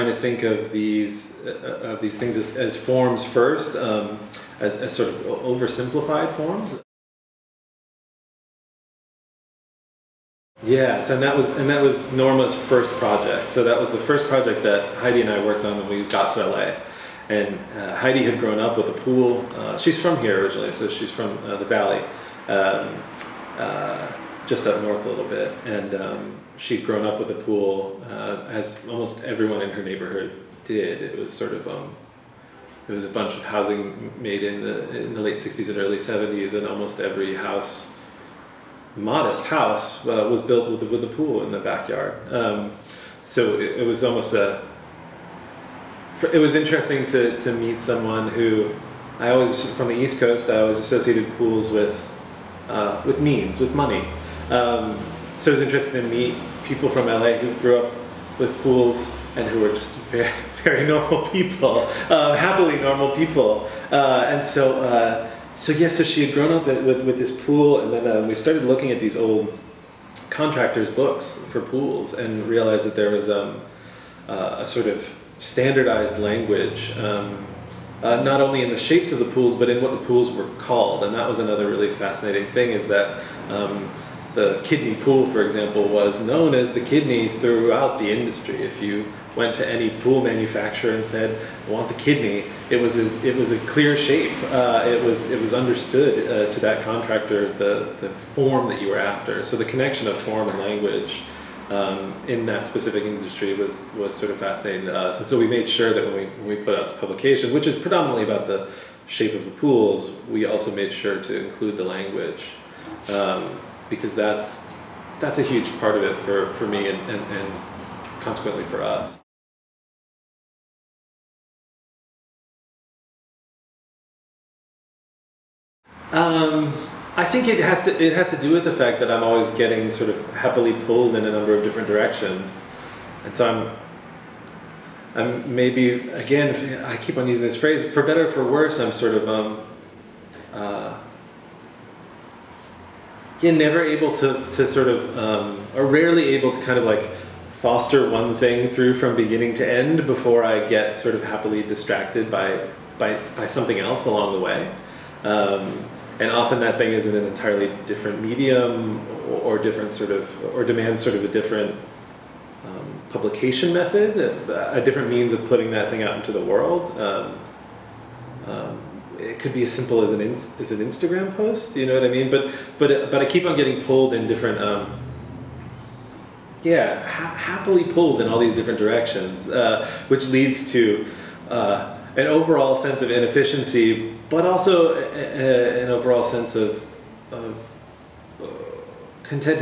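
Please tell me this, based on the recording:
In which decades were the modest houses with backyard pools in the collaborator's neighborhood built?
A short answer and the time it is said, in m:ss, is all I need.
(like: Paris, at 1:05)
late '60s and early '70s, at 0:35.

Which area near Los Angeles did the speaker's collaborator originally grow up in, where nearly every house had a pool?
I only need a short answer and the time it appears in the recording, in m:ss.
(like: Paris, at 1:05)
the valley, at 0:21.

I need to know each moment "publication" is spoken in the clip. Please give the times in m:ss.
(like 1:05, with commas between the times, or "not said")
1:46, 2:43.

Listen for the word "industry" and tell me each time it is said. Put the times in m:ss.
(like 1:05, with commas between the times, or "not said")
1:28, 1:43.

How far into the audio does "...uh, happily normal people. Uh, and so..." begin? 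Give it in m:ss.
1:02.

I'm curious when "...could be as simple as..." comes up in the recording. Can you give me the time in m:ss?
2:49.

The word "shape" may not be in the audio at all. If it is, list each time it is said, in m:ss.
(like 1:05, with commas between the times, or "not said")
1:18, 1:33, 1:49.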